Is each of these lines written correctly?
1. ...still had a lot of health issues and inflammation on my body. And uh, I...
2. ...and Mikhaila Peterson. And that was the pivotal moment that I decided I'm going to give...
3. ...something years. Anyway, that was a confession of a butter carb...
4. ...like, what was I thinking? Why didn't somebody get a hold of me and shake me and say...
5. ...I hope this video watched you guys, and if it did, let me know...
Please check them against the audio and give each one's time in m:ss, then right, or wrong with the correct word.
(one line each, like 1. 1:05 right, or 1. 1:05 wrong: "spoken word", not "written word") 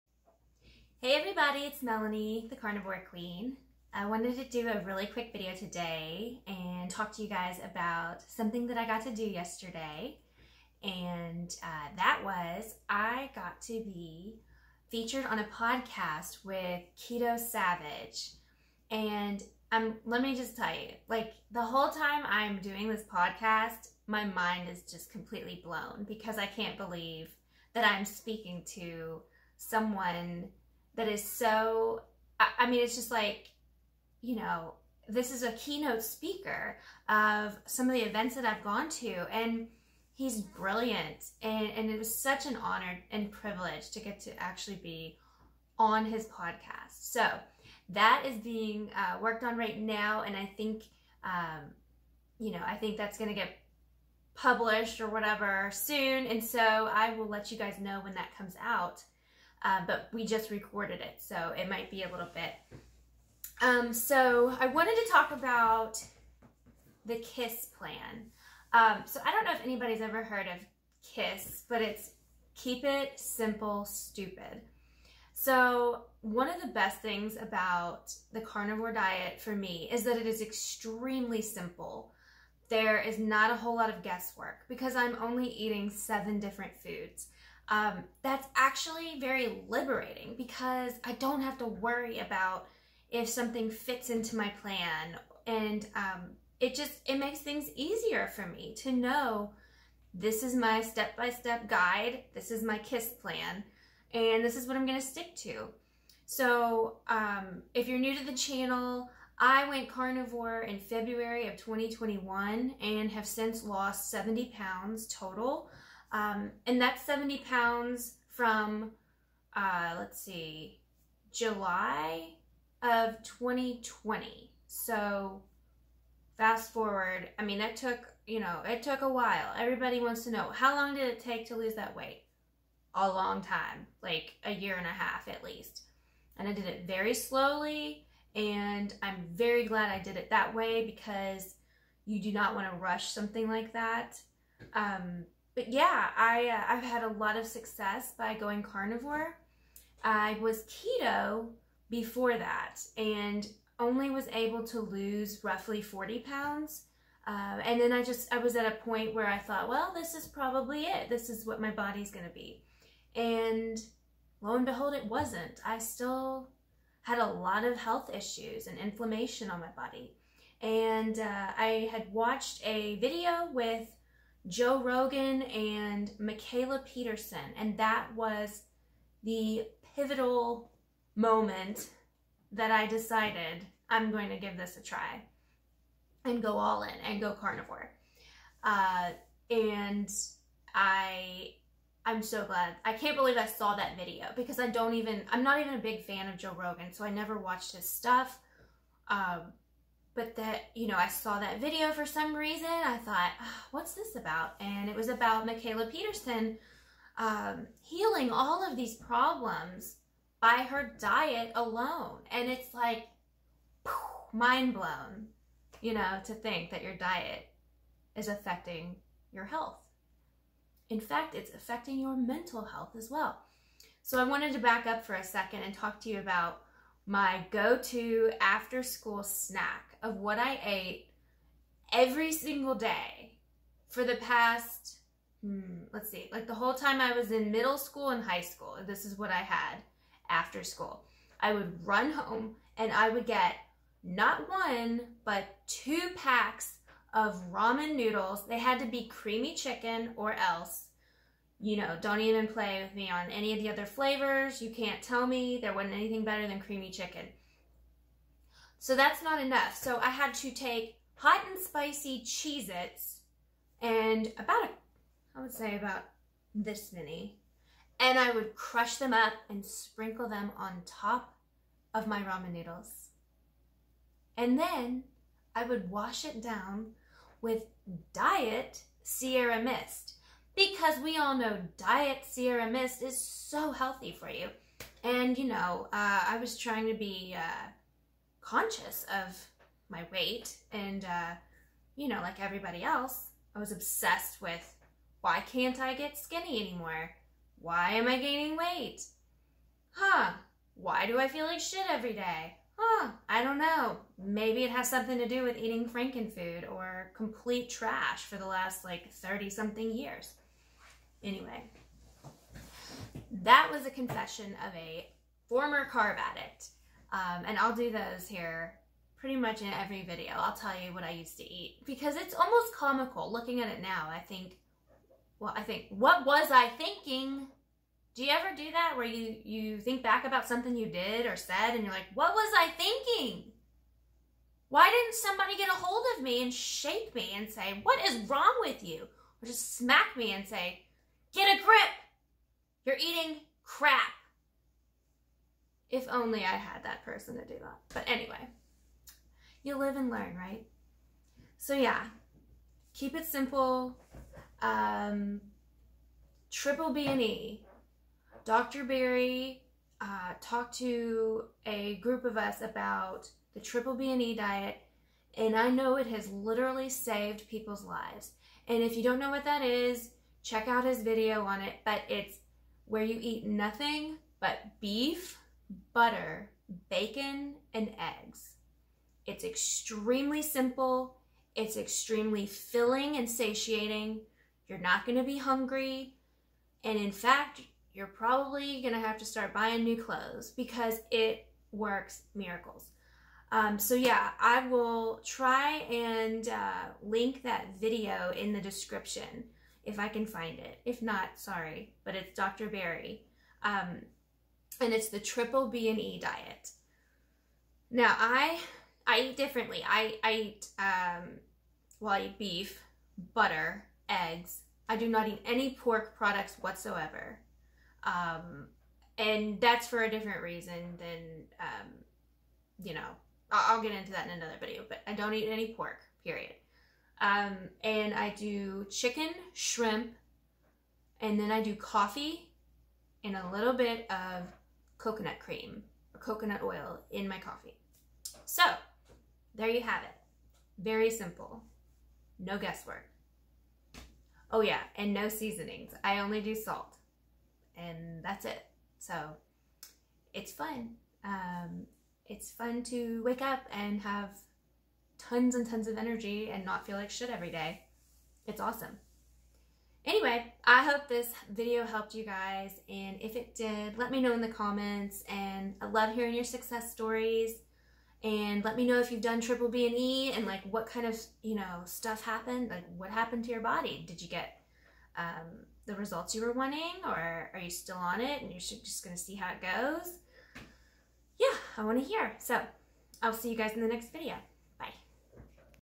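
1. 2:45 right
2. 2:55 right
3. 5:09 wrong: "former", not "butter"
4. 5:31 right
5. 7:40 wrong: "helped", not "watched".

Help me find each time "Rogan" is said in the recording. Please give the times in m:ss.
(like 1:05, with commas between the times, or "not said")
2:54, 3:16.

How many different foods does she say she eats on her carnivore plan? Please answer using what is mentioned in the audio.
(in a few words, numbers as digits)
7.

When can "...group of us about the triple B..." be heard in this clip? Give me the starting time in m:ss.
6:01.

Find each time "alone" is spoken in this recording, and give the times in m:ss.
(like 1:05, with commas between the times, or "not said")
3:31.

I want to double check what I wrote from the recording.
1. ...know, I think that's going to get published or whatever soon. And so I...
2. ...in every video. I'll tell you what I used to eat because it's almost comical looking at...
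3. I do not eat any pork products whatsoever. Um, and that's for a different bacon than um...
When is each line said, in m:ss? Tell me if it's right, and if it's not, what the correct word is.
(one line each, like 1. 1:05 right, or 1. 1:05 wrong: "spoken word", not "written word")
1. 0:52 right
2. 5:19 right
3. 6:54 wrong: "reason", not "bacon".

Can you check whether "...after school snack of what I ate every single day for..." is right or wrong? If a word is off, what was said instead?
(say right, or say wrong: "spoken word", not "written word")
right.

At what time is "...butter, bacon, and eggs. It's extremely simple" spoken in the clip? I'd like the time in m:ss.
6:15.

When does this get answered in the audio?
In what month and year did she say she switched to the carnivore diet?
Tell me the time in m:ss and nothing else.
1:50.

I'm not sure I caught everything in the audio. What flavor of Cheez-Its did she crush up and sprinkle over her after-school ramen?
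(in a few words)
hot and spicy.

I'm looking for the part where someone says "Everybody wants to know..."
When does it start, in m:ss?
2:09.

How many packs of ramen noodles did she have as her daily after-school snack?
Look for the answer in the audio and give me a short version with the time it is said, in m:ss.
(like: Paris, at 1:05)
2, at 4:05.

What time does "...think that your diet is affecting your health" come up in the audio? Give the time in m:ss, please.
3:36.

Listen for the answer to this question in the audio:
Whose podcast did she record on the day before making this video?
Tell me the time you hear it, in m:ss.
0:16.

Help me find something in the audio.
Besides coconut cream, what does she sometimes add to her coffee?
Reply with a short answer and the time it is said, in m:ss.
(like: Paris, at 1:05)
coconut oil, at 7:16.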